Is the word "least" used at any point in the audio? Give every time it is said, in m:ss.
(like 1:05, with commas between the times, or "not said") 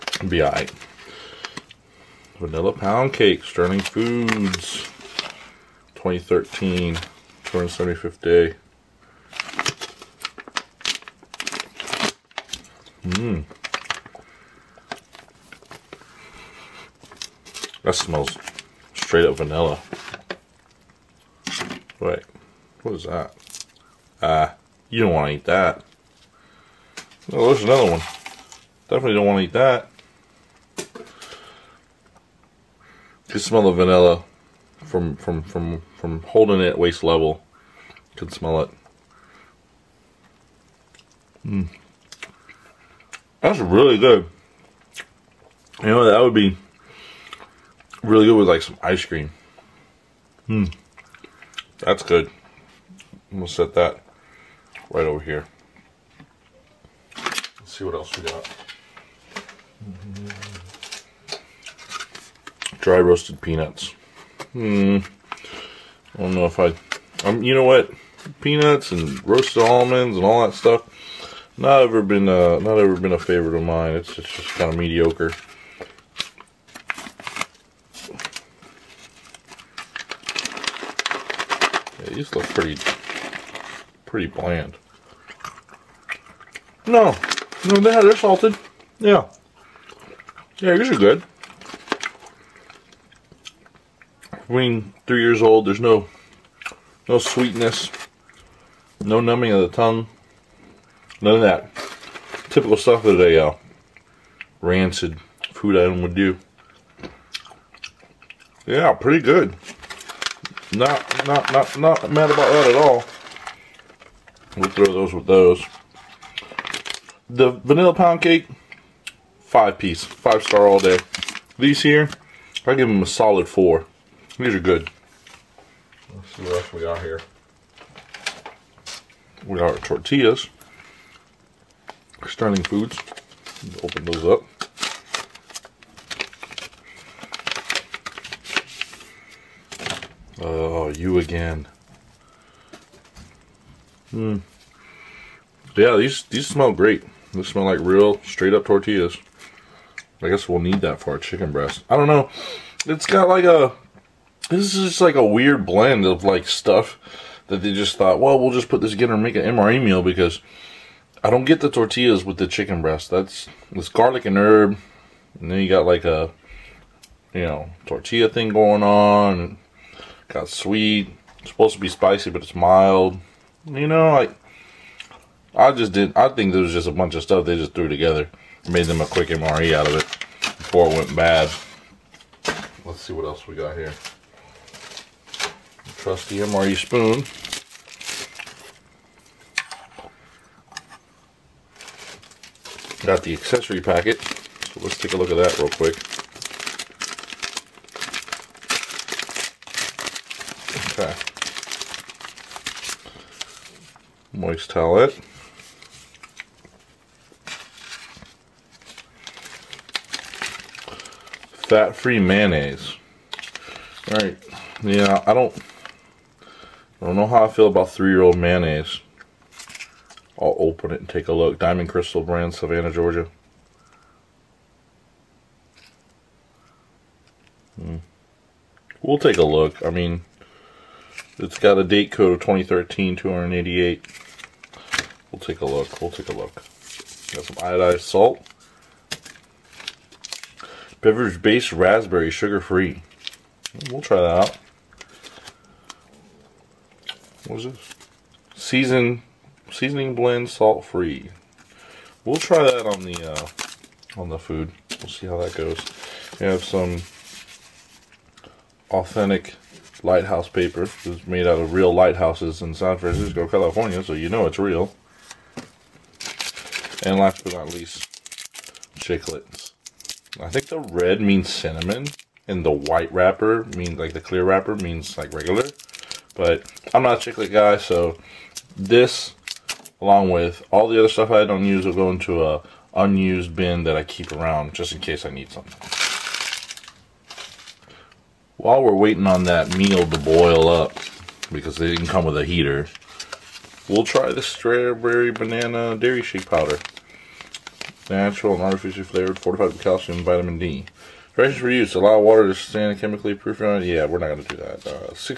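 4:27.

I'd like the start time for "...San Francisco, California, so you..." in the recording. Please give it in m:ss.
4:22.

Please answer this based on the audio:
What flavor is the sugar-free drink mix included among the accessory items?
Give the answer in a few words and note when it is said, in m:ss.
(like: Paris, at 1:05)
raspberry, at 4:01.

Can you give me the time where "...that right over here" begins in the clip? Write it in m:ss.
0:53.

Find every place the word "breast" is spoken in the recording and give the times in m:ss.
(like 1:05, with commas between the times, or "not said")
2:31, 2:42.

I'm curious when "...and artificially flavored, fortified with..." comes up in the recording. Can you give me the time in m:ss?
4:58.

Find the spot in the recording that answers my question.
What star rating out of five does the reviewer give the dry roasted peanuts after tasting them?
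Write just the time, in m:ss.
2:03.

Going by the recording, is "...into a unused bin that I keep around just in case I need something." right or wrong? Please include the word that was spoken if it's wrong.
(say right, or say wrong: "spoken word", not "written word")
right.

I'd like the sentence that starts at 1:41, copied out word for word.
None of that typical stuff that a uh, rancid food item would do.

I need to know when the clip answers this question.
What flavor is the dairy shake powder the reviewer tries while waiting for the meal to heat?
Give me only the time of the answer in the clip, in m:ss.
4:54.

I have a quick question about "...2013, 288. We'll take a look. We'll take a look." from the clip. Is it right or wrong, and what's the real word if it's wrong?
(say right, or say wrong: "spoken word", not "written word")
right.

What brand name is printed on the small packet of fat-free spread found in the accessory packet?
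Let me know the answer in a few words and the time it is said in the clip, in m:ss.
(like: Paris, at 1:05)
Diamond Crystal, at 3:41.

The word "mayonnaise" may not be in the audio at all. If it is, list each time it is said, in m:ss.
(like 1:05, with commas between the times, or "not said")
3:32, 3:38.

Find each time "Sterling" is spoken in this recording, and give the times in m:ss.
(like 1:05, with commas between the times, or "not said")
0:03, 2:12.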